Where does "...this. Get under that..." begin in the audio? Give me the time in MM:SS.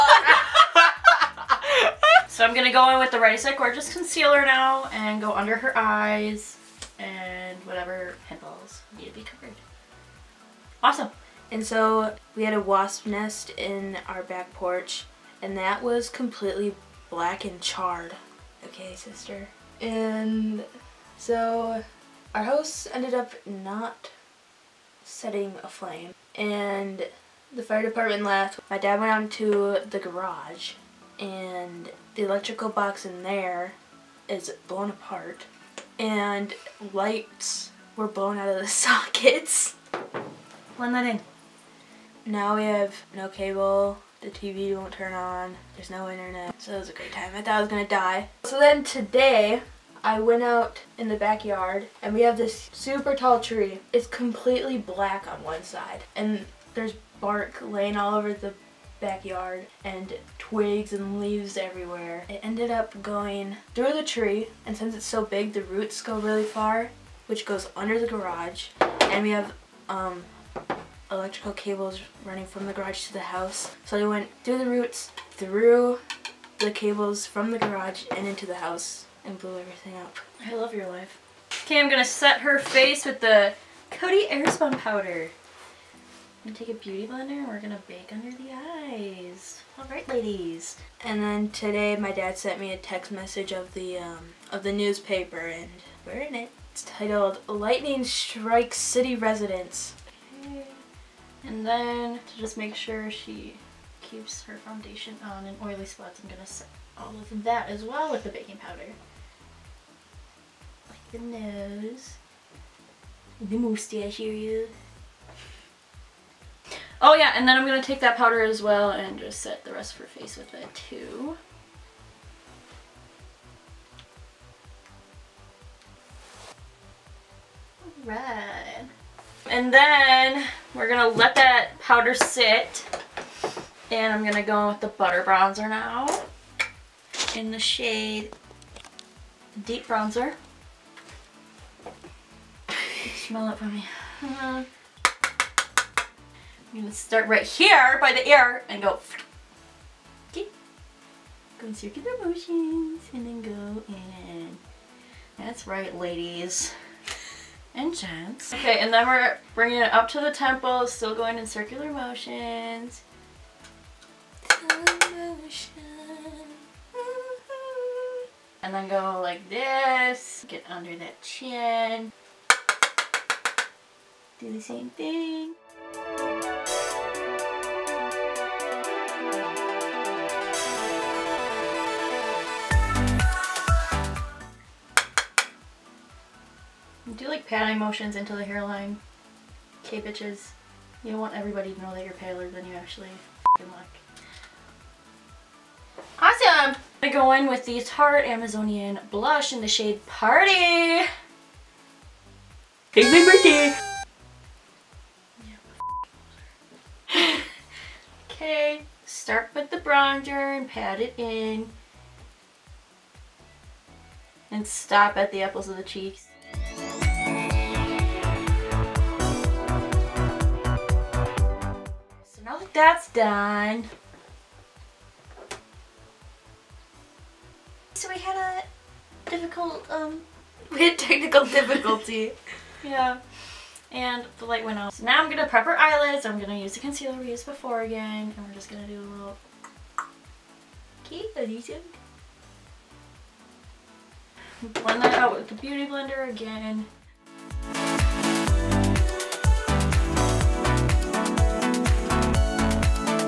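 02:49.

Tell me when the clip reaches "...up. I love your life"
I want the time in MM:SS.
01:19.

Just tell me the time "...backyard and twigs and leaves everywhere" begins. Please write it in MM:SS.
00:58.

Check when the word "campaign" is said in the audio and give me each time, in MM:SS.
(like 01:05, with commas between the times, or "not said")
not said.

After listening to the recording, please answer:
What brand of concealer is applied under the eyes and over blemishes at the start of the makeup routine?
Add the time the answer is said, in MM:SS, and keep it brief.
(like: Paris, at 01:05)
Ready Set Gorgeous, at 00:03.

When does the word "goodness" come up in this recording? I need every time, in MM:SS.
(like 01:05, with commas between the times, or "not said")
not said.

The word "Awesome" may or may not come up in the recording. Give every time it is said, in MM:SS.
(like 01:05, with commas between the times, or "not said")
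00:10, 03:16.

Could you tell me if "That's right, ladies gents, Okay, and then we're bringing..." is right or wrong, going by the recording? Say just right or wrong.
right.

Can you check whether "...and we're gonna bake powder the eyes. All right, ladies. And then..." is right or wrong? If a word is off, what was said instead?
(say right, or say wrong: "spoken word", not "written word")
wrong: "under", not "powder".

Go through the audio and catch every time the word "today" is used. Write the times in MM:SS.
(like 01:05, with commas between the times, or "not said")
00:48, 01:31.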